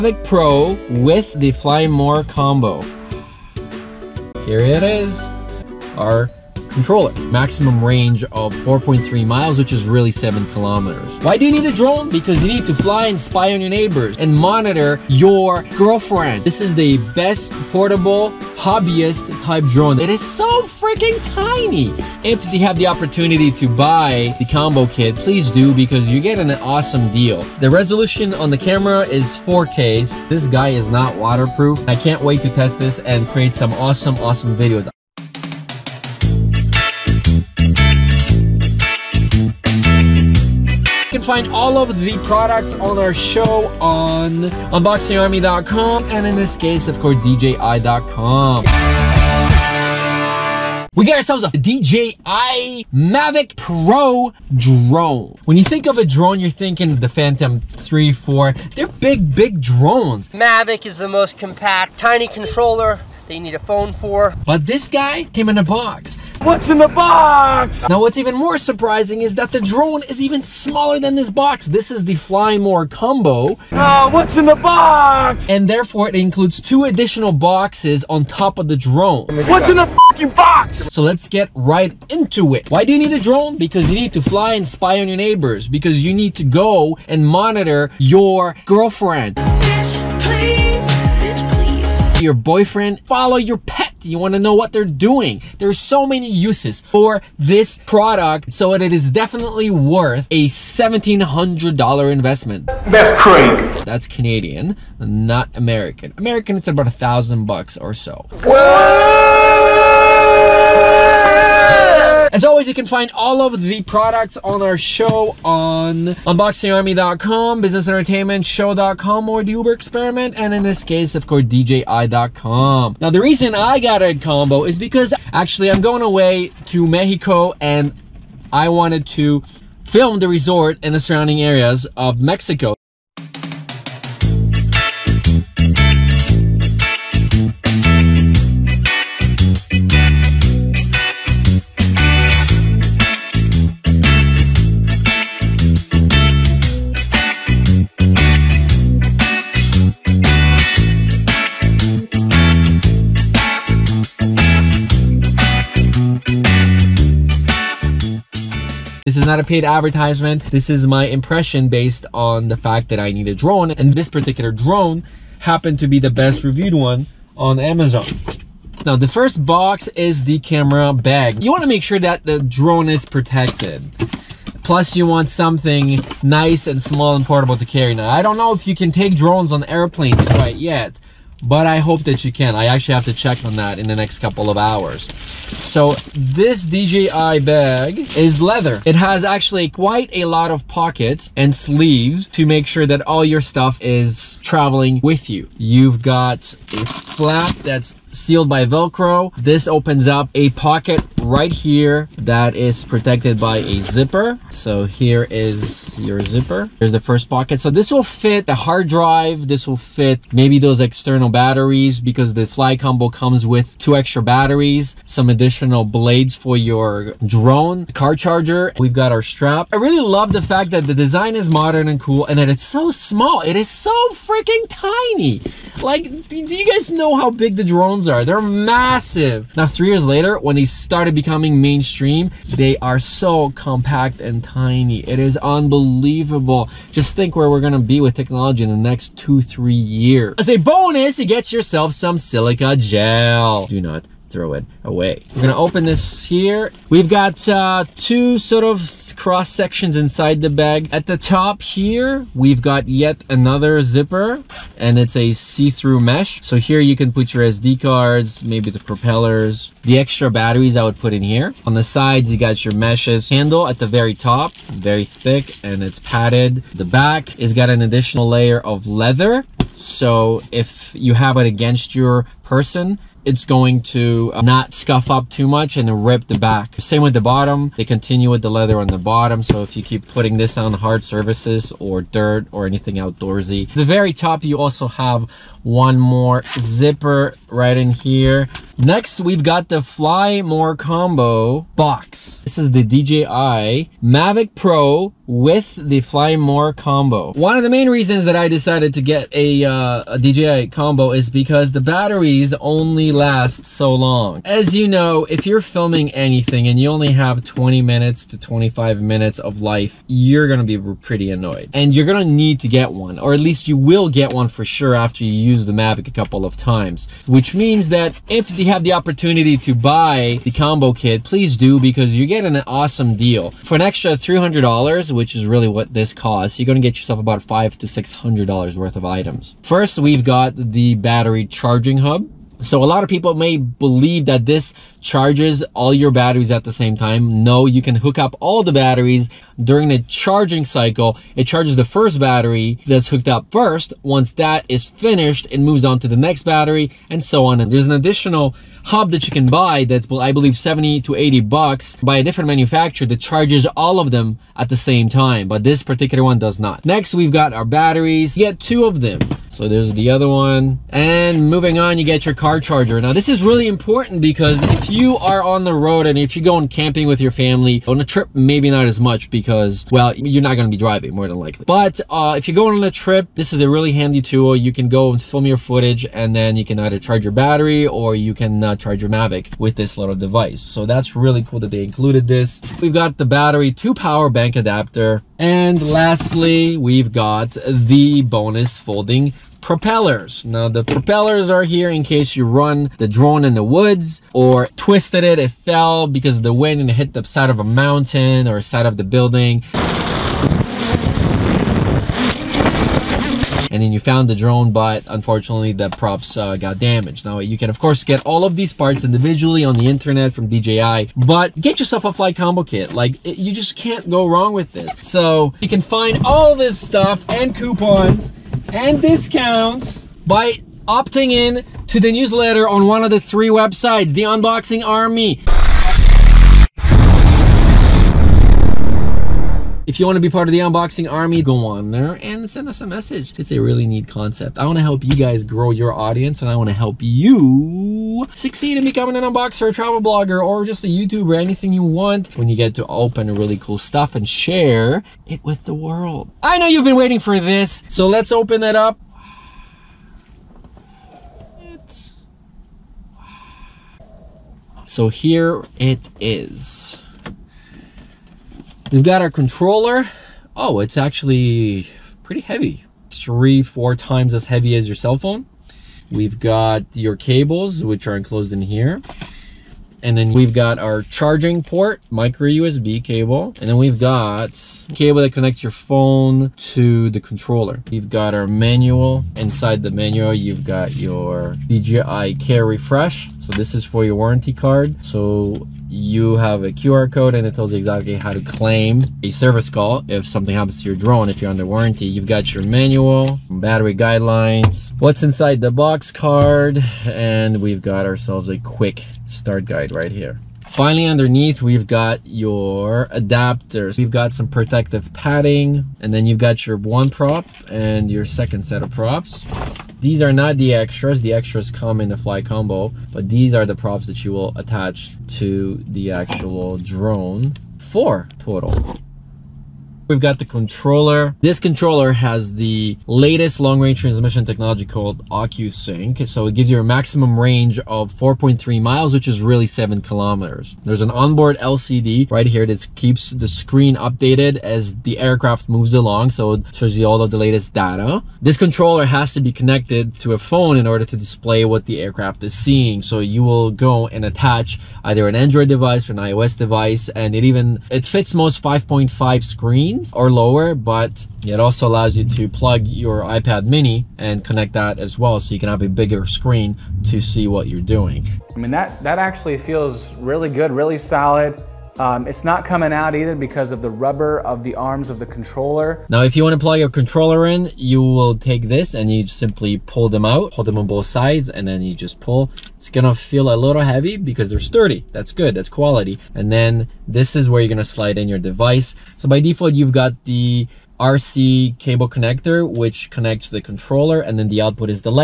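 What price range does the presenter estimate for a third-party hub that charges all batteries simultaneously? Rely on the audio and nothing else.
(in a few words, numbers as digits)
70 to 80 bucks.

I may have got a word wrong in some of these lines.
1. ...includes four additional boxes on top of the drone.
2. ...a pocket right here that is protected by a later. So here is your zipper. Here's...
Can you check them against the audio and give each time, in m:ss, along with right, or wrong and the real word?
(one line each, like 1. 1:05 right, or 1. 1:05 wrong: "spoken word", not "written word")
1. 1:16 wrong: "two", not "four"
2. 3:20 wrong: "zipper", not "later".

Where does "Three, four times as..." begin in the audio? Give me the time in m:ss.
7:43.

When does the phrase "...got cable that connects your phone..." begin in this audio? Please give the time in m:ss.
7:53.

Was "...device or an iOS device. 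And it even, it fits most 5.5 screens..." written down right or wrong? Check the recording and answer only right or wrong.
right.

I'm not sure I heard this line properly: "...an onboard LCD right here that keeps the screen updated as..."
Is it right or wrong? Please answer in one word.
right.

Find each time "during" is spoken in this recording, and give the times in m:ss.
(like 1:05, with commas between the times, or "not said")
5:39.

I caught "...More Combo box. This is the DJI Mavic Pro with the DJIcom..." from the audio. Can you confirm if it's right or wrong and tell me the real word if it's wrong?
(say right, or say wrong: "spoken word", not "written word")
wrong: "Fly", not "DJIcom".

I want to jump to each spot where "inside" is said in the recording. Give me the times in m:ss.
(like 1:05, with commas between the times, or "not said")
4:09, 7:59, 8:15.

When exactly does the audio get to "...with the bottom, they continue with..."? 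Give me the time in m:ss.
4:37.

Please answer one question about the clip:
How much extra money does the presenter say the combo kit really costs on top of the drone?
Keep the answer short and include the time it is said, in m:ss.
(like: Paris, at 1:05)
$300, at 5:24.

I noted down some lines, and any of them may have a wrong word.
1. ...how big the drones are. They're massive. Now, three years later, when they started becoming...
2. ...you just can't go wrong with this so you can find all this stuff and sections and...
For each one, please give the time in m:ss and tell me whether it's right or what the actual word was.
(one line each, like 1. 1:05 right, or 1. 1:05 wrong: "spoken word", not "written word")
1. 3:47 right
2. 6:53 wrong: "coupons", not "sections".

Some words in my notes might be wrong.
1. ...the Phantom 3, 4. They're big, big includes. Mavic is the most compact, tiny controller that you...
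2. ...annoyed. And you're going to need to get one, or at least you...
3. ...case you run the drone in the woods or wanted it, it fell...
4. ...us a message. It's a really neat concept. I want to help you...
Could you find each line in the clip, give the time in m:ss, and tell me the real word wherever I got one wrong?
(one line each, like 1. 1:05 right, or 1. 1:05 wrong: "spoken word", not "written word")
1. 0:56 wrong: "drones", not "includes"
2. 5:11 right
3. 6:32 wrong: "twisted", not "wanted"
4. 7:12 right.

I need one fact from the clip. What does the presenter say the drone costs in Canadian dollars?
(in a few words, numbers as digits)
$1,700.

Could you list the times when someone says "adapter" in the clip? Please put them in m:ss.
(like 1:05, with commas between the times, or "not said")
6:24, 8:23.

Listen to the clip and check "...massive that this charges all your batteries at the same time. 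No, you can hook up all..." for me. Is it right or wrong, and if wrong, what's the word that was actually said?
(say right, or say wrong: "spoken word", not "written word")
wrong: "believe", not "massive".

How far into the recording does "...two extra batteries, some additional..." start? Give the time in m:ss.
3:33.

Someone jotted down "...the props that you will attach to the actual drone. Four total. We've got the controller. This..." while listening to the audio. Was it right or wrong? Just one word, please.
right.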